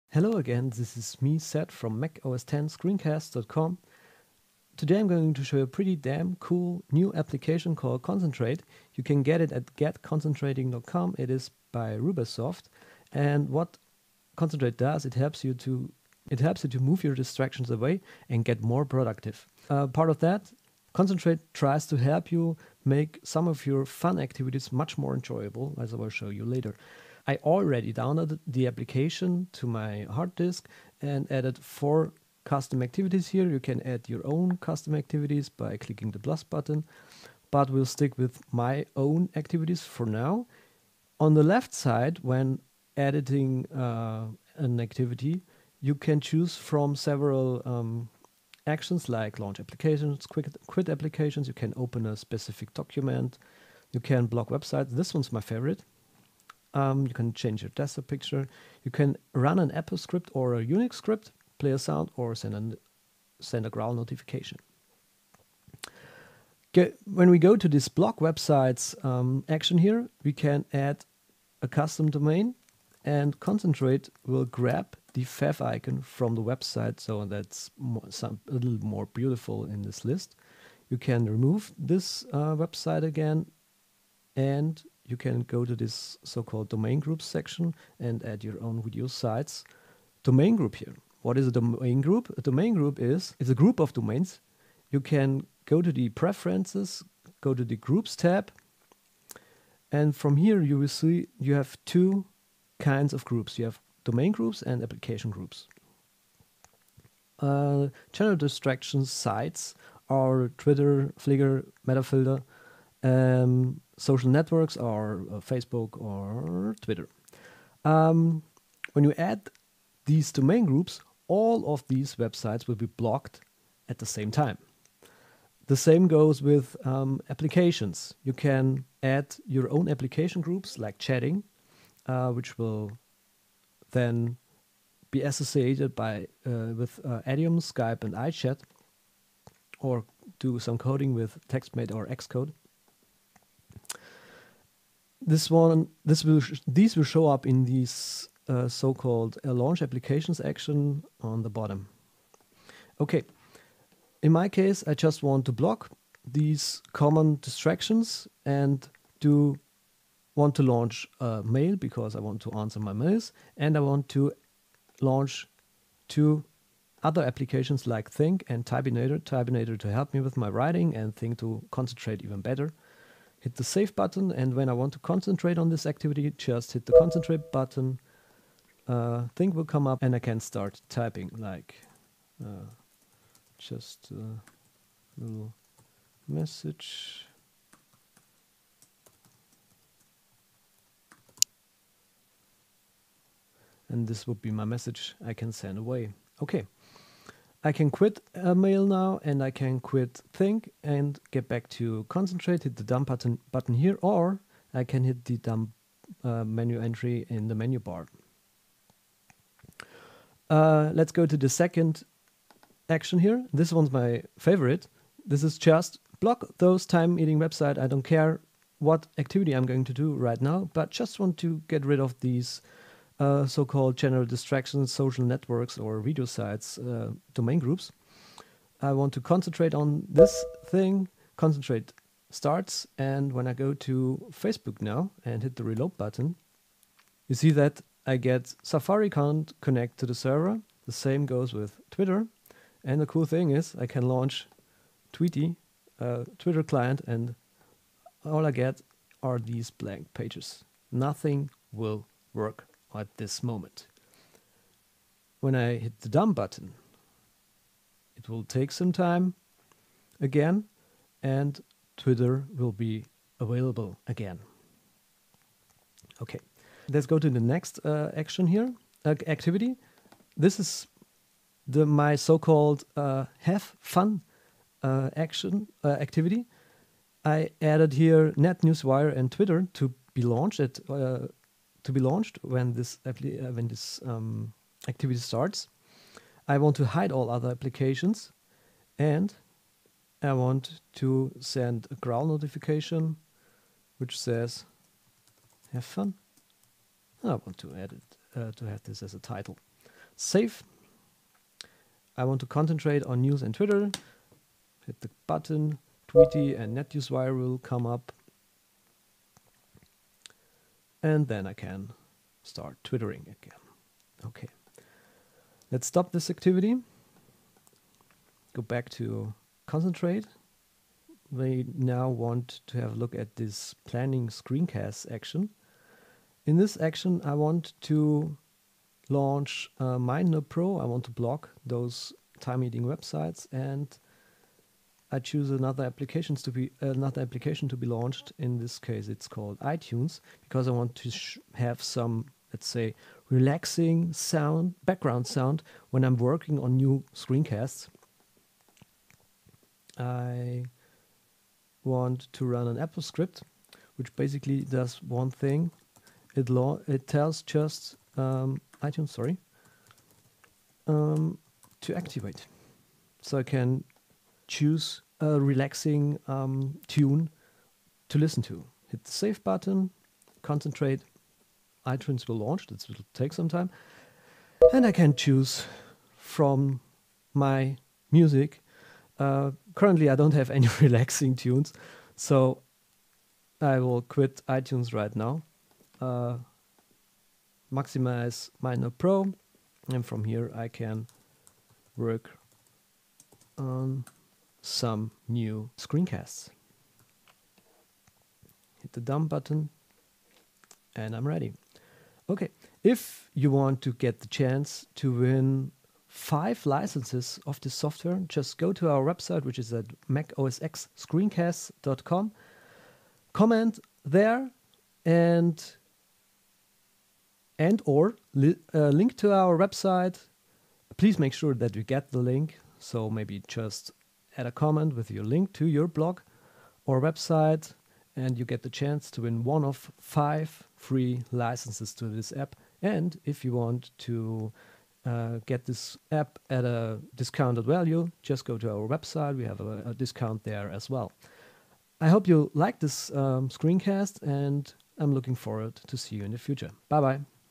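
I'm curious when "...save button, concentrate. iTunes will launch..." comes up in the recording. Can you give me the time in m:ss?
6:09.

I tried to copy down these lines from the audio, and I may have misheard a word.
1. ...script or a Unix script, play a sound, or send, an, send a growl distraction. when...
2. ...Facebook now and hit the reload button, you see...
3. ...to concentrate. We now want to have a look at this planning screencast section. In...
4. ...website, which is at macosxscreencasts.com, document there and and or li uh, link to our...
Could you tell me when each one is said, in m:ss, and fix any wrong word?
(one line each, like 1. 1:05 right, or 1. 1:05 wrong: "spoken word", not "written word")
1. 0:59 wrong: "notification", not "distraction"
2. 3:54 right
3. 5:18 wrong: "action", not "section"
4. 6:49 wrong: "comment", not "document".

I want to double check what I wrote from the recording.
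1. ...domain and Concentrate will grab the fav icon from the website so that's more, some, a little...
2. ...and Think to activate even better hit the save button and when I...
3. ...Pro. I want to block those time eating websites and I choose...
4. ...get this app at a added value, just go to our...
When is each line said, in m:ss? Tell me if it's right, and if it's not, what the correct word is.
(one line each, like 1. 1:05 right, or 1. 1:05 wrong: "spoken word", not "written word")
1. 1:12 right
2. 2:50 wrong: "concentrate", not "activate"
3. 5:30 right
4. 7:15 wrong: "discounted", not "added".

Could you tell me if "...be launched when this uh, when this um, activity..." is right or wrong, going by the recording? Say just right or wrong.
right.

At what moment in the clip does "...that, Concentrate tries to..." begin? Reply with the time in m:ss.
0:20.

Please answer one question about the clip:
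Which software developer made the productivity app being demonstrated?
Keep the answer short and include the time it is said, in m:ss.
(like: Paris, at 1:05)
roobaSoft, at 0:11.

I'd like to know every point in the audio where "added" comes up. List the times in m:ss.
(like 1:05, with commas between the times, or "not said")
0:31, 4:37.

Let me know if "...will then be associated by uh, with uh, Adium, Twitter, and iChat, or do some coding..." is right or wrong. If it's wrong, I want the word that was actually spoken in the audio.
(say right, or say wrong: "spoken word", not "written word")
wrong: "Skype", not "Twitter".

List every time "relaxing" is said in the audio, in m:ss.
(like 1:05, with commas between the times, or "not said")
5:43, 6:05, 6:20.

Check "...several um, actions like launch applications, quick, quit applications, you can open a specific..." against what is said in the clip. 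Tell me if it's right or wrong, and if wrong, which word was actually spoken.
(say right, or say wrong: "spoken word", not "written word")
right.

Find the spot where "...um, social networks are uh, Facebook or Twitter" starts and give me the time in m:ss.
1:53.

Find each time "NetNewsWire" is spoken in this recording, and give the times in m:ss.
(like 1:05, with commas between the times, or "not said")
4:38, 5:06.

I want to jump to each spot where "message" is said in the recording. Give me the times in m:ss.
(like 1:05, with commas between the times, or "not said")
3:06, 3:14.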